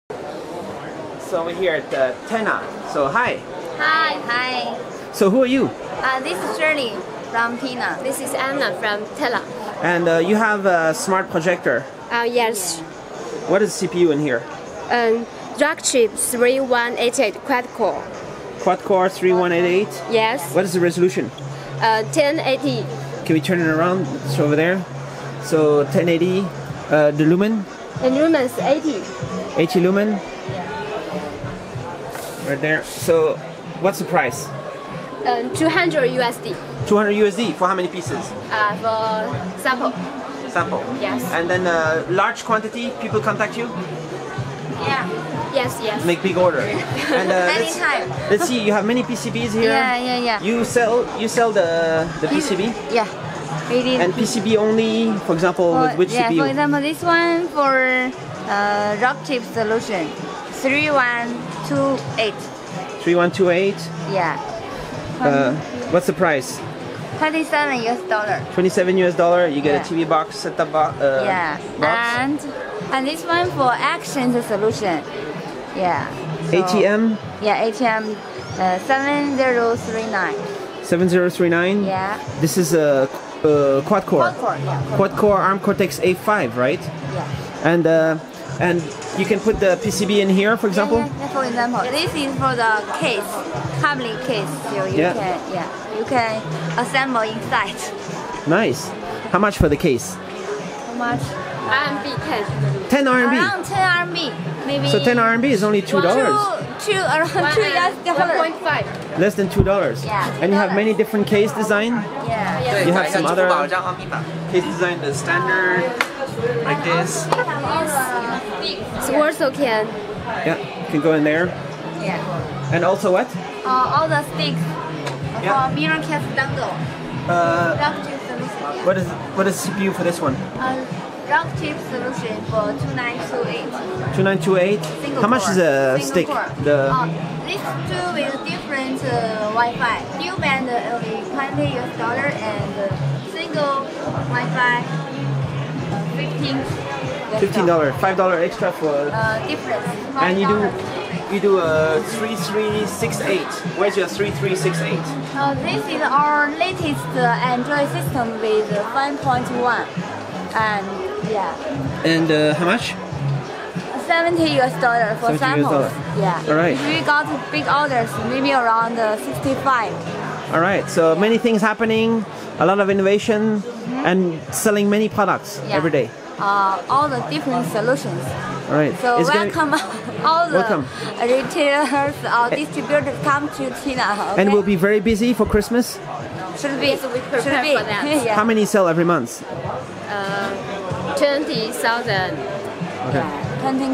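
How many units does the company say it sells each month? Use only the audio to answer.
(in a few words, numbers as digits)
20,000.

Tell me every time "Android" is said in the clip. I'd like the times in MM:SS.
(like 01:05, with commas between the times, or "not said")
02:37.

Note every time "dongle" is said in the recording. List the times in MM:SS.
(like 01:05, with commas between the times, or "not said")
02:06.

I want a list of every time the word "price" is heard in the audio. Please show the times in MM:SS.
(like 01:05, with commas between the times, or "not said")
00:34, 01:06.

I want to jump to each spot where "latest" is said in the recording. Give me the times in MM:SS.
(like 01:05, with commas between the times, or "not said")
02:36.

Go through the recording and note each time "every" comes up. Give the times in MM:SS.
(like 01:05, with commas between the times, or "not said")
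02:55, 03:08.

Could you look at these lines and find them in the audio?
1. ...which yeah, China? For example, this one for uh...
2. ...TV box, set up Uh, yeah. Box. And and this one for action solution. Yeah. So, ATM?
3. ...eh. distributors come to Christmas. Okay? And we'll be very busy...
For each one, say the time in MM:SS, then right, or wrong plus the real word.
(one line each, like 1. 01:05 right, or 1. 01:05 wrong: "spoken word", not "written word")
1. 00:56 wrong: "CPU", not "China"
2. 01:10 right
3. 03:02 wrong: "China", not "Christmas".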